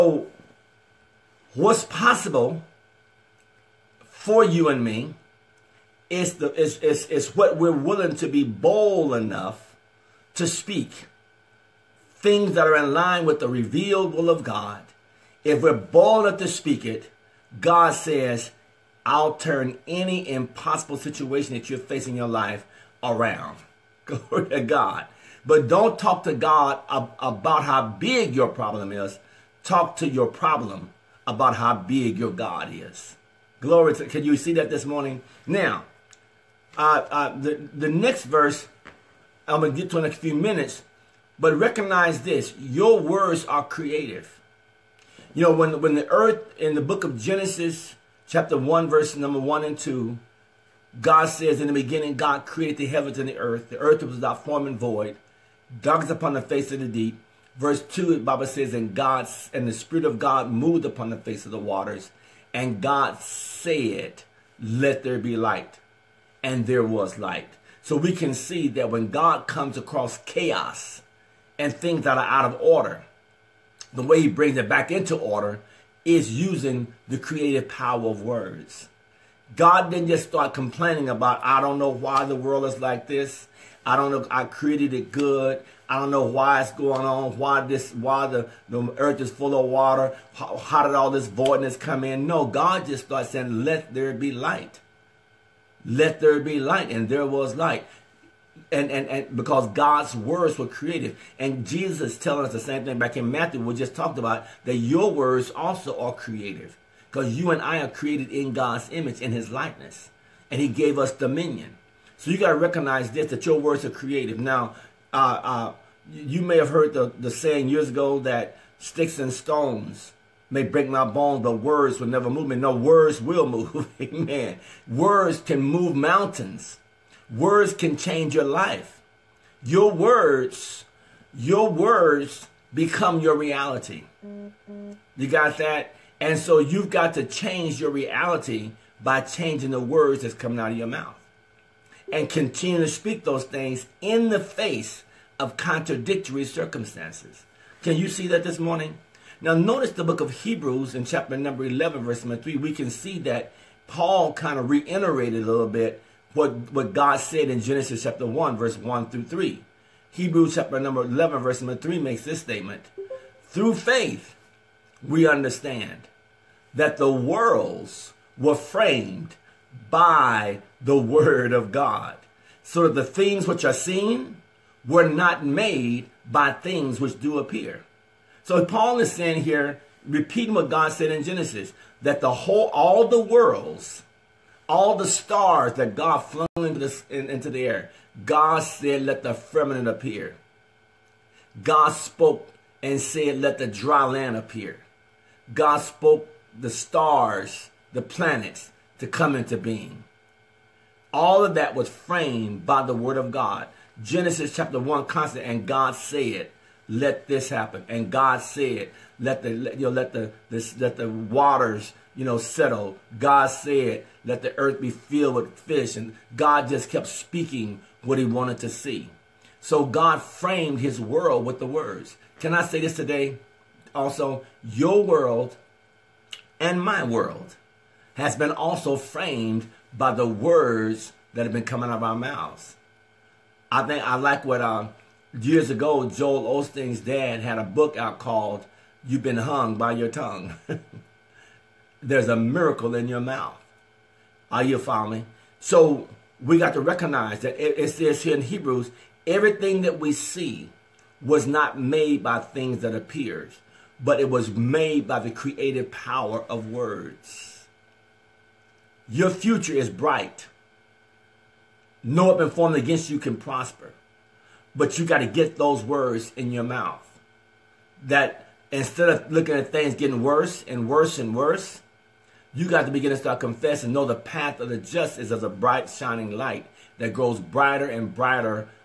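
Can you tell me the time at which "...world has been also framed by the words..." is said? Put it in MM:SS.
03:47.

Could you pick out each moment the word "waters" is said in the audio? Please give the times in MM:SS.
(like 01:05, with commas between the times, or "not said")
01:01, 01:29, 03:31.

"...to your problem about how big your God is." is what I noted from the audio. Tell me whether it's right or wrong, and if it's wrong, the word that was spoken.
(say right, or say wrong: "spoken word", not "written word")
right.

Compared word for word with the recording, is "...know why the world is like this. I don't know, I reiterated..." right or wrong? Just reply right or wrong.
wrong.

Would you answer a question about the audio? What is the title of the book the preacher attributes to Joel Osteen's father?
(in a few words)
You've been hung by your tongue.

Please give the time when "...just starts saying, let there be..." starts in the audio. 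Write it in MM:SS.
01:32.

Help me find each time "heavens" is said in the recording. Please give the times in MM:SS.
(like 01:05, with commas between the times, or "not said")
00:52.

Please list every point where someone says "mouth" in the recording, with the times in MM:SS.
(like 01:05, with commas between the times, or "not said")
02:20, 03:52, 04:03, 04:26.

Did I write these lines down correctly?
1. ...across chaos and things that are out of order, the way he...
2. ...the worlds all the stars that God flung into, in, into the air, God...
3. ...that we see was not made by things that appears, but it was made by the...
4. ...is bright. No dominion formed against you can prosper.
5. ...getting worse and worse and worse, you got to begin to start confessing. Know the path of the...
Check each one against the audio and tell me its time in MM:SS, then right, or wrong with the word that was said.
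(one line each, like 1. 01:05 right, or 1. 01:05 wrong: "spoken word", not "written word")
1. 01:09 right
2. 03:03 right
3. 04:09 right
4. 04:19 wrong: "weapon", not "dominion"
5. 04:29 right.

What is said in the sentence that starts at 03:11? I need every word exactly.
God spoke and said, let the dry land appear.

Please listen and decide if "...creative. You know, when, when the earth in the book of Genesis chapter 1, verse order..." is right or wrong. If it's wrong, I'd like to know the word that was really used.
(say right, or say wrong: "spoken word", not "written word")
wrong: "number", not "order".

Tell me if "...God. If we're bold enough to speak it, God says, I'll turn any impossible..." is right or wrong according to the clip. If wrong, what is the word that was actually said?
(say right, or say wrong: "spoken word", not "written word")
right.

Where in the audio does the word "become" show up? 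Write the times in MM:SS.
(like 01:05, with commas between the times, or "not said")
02:12.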